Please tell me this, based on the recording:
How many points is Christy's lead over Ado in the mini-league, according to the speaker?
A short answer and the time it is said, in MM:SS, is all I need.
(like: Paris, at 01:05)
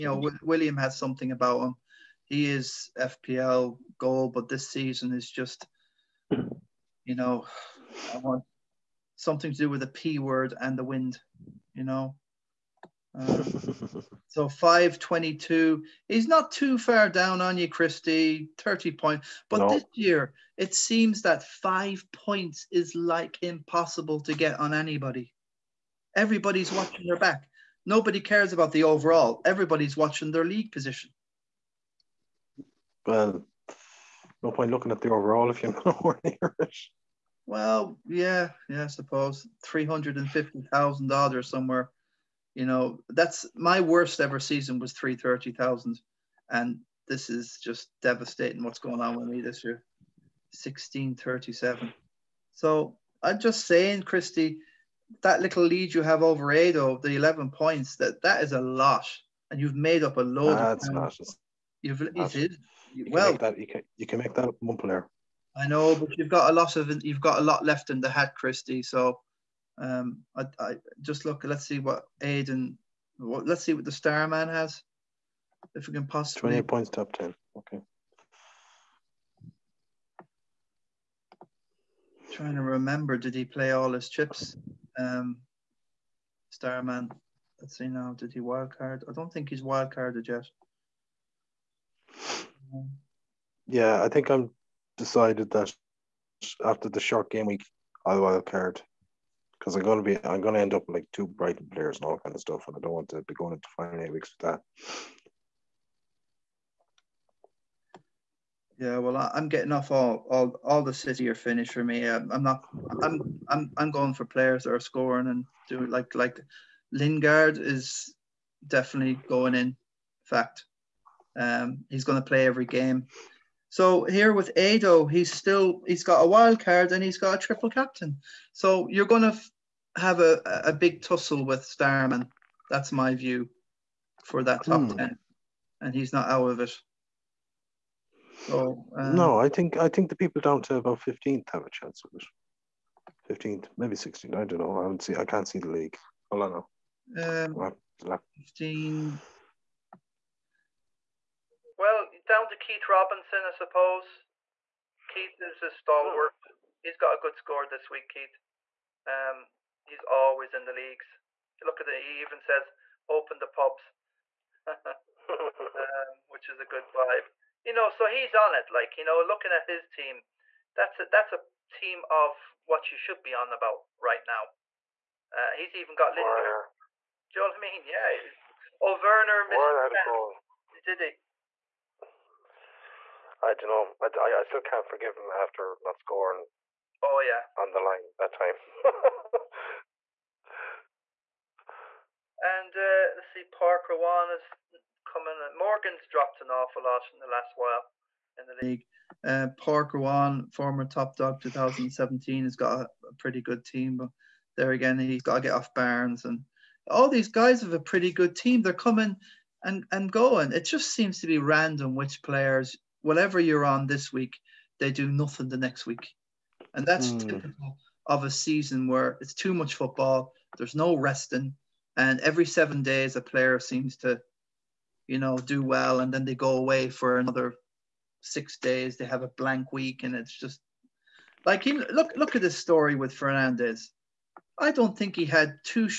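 11, at 00:57.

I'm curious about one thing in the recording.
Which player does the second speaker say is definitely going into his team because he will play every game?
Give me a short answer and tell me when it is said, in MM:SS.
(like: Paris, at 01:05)
Lingard, at 01:56.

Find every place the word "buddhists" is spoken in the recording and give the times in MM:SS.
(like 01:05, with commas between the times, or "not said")
not said.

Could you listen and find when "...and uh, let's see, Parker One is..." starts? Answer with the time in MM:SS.
03:12.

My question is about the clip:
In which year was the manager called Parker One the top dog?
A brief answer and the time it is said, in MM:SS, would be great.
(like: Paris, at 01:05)
2017, at 03:21.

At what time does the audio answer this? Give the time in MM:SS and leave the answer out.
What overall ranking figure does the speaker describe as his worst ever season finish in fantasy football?
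00:44.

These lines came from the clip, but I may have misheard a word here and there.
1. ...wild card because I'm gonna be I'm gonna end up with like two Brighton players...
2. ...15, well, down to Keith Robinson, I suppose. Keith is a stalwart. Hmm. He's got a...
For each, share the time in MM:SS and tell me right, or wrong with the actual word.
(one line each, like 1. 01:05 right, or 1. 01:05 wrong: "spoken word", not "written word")
1. 01:38 right
2. 02:28 right.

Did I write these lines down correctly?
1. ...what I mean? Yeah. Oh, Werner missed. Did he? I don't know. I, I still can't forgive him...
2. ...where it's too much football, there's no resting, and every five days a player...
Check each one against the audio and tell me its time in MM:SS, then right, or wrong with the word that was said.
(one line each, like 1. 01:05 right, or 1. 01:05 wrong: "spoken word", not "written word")
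1. 02:57 right
2. 03:38 wrong: "seven", not "five".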